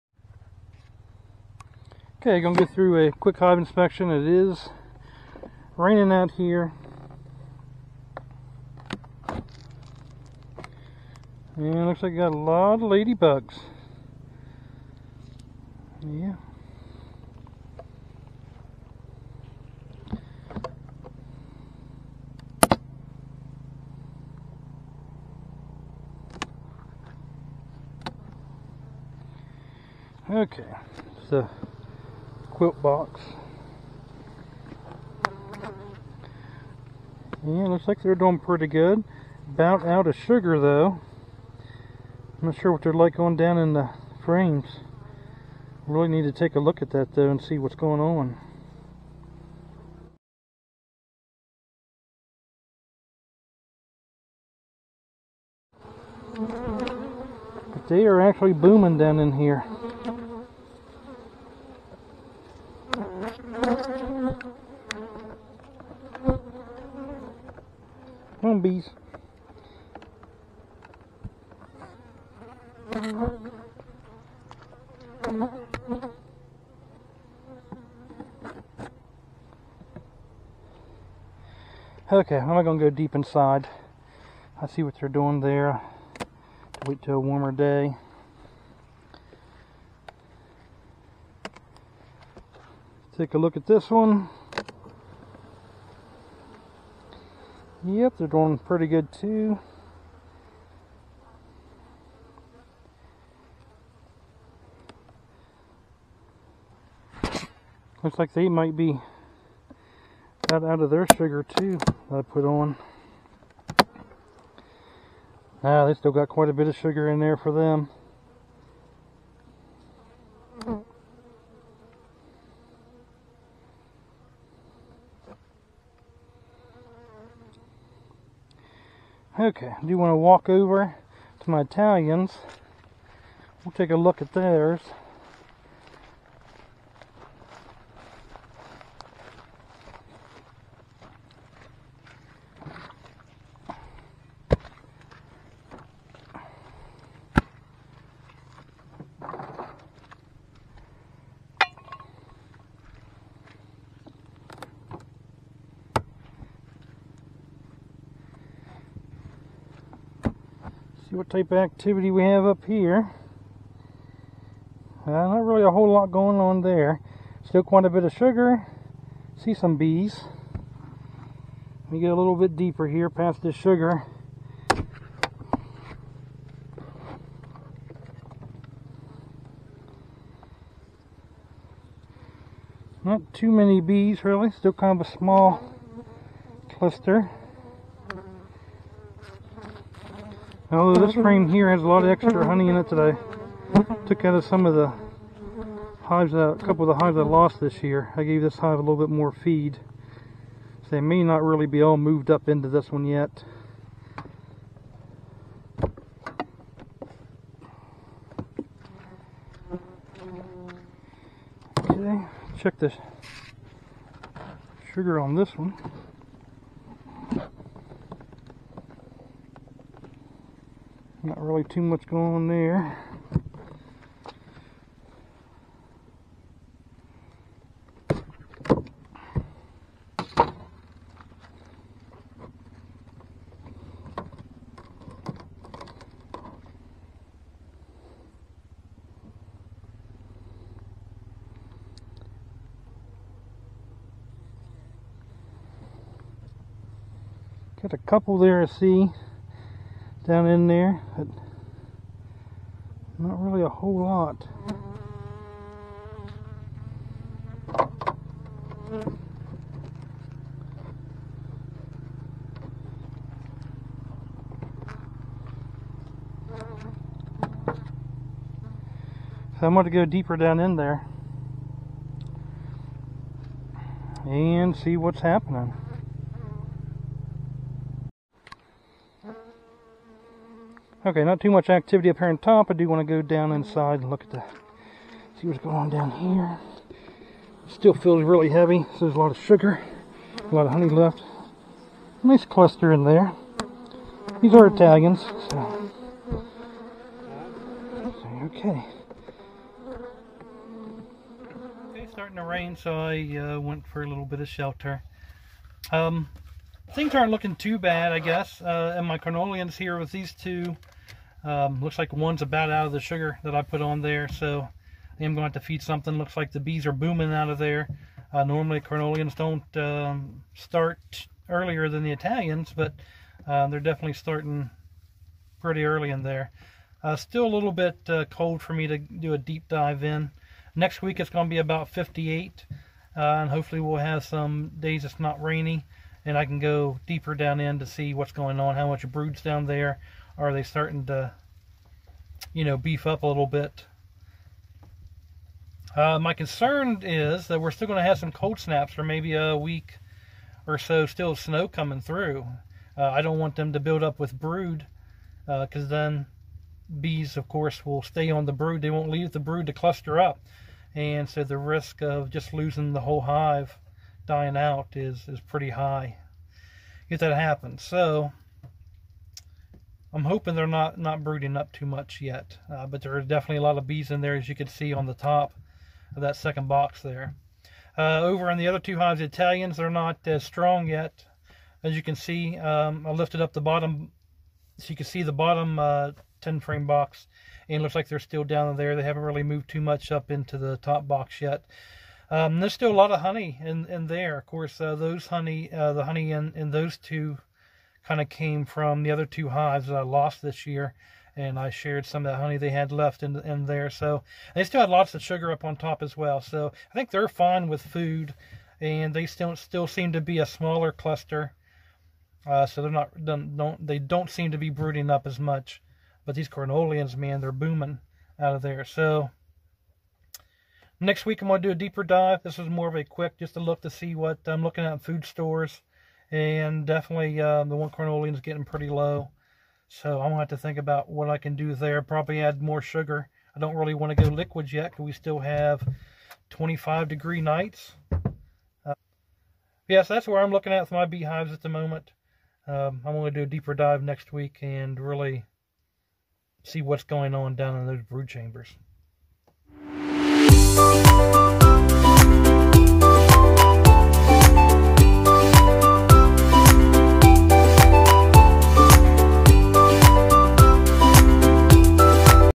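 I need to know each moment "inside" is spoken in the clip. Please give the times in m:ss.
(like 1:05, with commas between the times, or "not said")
1:23, 4:43.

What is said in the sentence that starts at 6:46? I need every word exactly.
So I think they're fine with food.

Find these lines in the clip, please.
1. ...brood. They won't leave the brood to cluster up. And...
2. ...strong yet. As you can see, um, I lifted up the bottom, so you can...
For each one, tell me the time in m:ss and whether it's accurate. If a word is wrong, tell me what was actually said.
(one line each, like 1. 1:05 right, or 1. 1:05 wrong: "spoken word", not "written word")
1. 5:58 right
2. 6:20 right.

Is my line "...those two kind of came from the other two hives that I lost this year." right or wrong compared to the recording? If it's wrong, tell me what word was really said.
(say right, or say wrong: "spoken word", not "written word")
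right.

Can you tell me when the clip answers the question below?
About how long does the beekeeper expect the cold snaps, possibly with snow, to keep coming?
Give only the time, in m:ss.
5:49.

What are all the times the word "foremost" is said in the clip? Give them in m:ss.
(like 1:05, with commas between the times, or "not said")
not said.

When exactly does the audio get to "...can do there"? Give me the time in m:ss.
7:11.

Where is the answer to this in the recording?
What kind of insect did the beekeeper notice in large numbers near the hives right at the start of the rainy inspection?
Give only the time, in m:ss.
0:12.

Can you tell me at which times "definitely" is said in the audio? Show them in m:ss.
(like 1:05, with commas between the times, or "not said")
5:23, 6:13, 7:06.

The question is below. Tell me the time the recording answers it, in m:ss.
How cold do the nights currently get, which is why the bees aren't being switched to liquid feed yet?
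7:16.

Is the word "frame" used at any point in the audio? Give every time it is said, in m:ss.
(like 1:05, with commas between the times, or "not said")
0:44, 3:11, 6:26.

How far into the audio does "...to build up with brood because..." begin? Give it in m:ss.
5:53.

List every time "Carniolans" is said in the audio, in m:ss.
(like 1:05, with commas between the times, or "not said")
5:09, 5:18, 6:56, 7:07.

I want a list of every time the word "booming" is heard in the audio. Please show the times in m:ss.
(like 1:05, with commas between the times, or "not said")
0:58, 5:16, 6:57.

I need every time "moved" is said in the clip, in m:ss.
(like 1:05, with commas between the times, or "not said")
3:21, 6:29.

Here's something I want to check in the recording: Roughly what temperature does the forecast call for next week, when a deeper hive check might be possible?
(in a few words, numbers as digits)
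58.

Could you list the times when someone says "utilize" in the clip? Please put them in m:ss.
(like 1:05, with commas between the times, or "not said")
not said.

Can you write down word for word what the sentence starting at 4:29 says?
So I'm going to go deeper down in there and see what's happening.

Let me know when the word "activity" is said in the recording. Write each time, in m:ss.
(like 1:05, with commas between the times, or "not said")
2:41, 4:41.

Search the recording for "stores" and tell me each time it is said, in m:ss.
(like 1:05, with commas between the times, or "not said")
7:05.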